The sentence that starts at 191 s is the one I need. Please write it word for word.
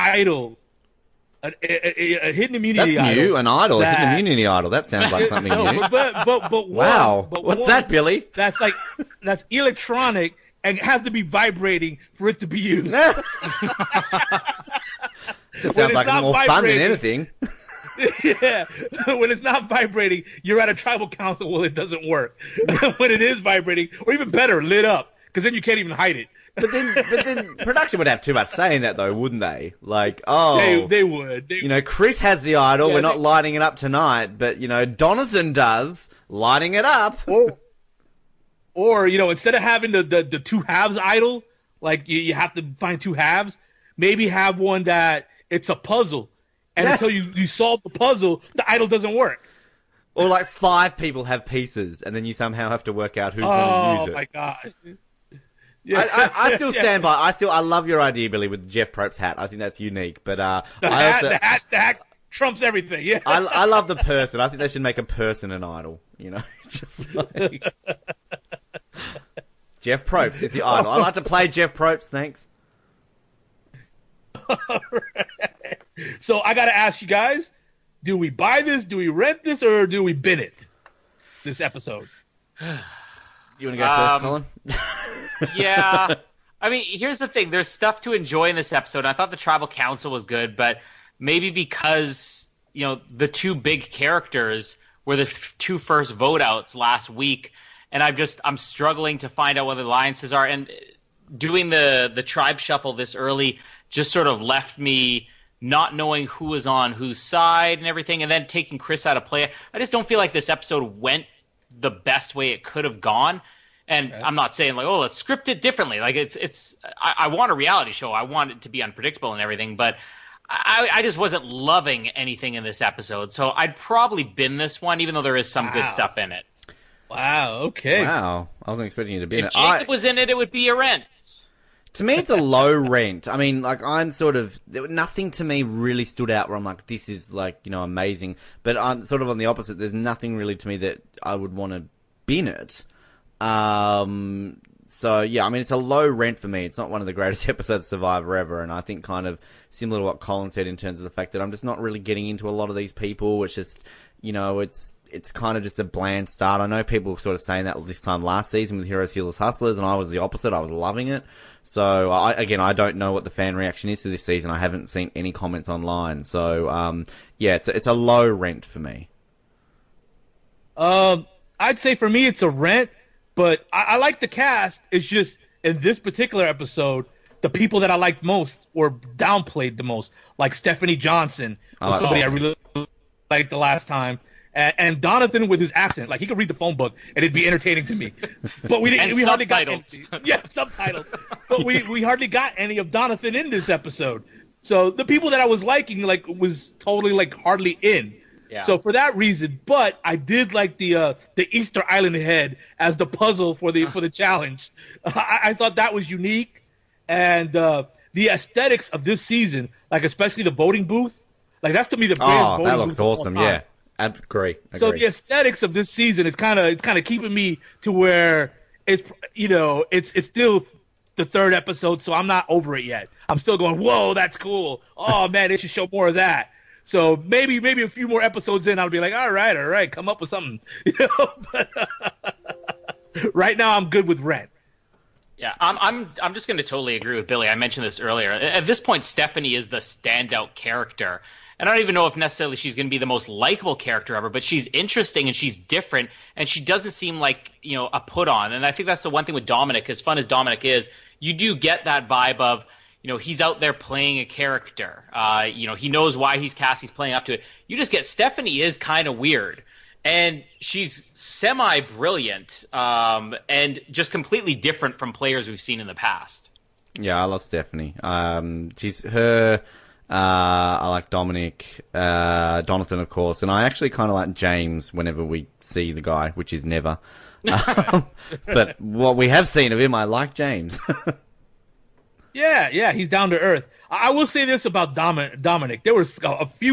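but we we hardly got any of Donathan in this episode.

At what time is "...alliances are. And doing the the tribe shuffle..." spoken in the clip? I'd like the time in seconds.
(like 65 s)
99 s.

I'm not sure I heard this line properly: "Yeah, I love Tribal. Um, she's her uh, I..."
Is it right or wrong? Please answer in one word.
wrong.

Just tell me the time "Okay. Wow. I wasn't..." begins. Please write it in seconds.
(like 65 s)
127 s.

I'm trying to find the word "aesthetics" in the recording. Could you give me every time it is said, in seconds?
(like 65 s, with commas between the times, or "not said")
208 s, 215 s.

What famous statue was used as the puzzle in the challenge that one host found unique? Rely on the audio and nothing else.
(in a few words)
Easter Island head.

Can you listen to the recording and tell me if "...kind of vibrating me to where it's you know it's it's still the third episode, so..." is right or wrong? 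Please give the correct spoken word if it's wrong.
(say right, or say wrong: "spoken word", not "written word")
wrong: "keeping", not "vibrating".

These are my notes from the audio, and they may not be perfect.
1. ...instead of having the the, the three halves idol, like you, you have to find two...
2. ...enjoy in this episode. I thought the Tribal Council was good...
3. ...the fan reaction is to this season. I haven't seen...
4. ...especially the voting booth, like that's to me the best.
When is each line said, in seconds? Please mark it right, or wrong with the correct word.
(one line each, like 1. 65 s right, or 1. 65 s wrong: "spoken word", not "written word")
1. 39 s wrong: "two", not "three"
2. 88 s right
3. 163 s right
4. 210 s right.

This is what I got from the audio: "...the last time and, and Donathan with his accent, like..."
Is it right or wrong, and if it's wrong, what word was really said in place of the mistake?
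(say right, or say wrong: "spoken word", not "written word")
right.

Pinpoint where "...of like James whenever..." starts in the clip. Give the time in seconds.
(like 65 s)
274 s.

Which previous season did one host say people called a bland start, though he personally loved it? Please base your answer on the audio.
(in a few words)
Heroes, Healers, Hustlers.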